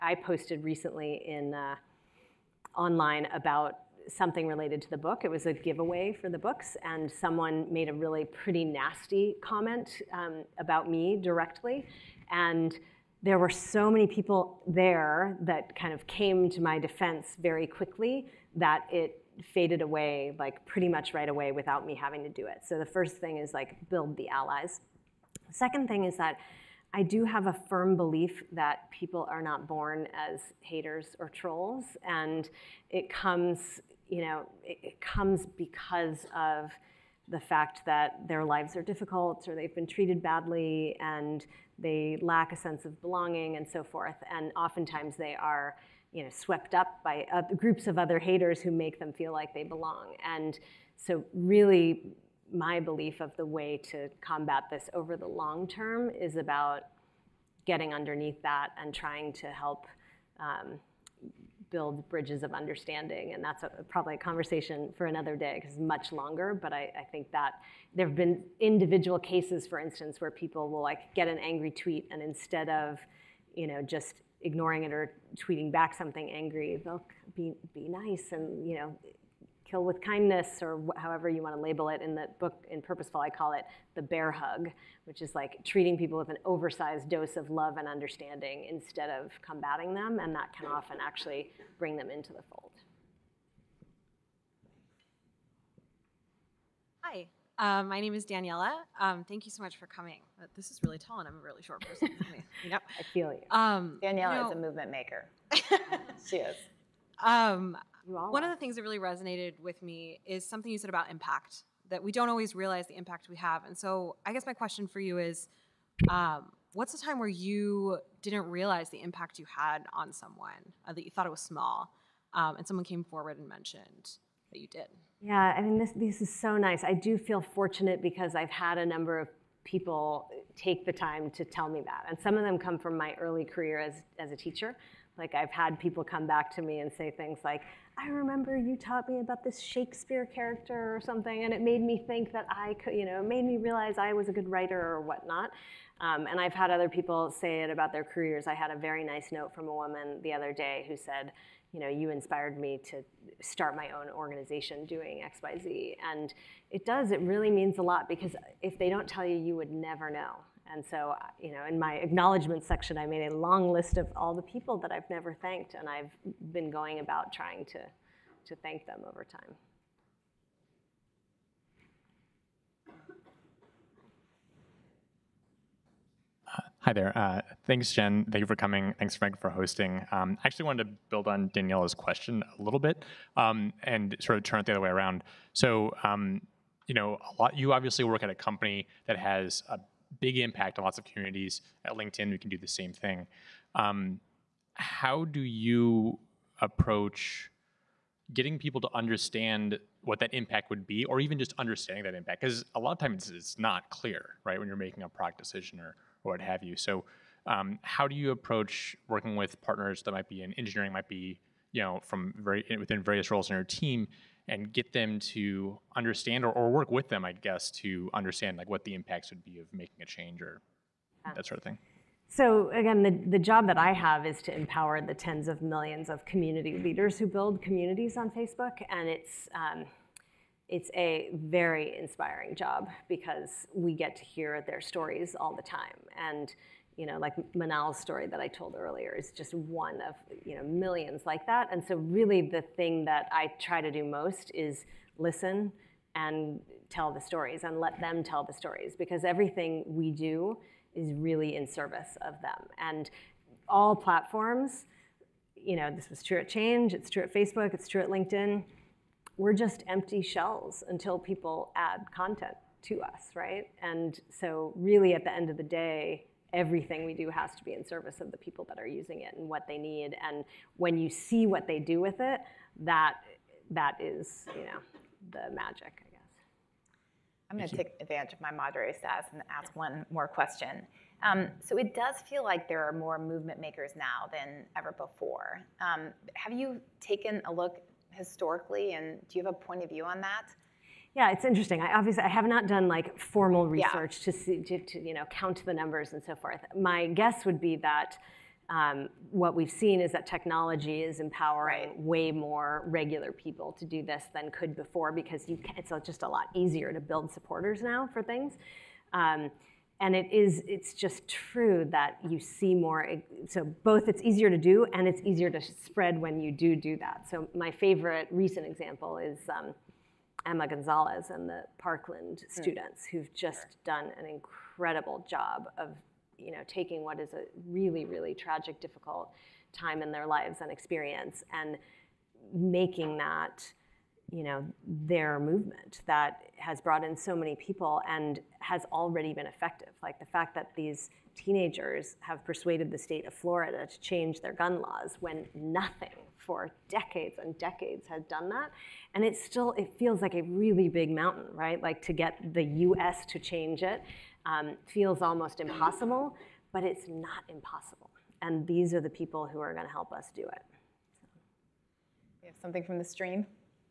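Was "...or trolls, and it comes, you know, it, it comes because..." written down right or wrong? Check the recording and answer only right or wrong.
right.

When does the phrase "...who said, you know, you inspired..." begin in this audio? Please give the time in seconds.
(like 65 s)
150 s.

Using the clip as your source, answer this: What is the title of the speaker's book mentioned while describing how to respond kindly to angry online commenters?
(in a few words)
Purposeful.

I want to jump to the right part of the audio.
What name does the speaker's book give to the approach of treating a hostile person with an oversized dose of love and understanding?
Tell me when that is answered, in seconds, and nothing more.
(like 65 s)
83 s.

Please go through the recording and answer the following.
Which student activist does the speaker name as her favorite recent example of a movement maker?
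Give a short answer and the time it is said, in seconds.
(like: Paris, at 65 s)
Emma Gonzalez, at 320 s.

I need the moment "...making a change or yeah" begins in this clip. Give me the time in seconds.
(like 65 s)
219 s.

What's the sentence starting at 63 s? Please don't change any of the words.
And that's a, probably a conversation for another day because it's much longer.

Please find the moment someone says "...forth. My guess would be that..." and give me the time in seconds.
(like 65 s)
296 s.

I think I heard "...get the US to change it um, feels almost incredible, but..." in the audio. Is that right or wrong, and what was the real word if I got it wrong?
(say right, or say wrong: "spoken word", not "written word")
wrong: "impossible", not "incredible".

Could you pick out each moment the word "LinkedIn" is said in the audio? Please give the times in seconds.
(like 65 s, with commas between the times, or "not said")
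191 s, 258 s.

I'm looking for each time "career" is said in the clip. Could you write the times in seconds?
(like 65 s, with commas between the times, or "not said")
133 s, 148 s.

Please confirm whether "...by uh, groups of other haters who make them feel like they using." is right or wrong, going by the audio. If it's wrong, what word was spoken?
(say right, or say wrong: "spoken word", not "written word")
wrong: "belong", not "using".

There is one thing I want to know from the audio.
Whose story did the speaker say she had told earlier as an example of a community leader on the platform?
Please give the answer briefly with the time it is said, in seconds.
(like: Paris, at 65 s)
Manal, at 237 s.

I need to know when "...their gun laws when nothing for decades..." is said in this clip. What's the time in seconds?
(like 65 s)
344 s.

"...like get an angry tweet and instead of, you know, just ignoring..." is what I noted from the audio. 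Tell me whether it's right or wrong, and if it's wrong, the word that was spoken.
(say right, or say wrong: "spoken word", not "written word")
right.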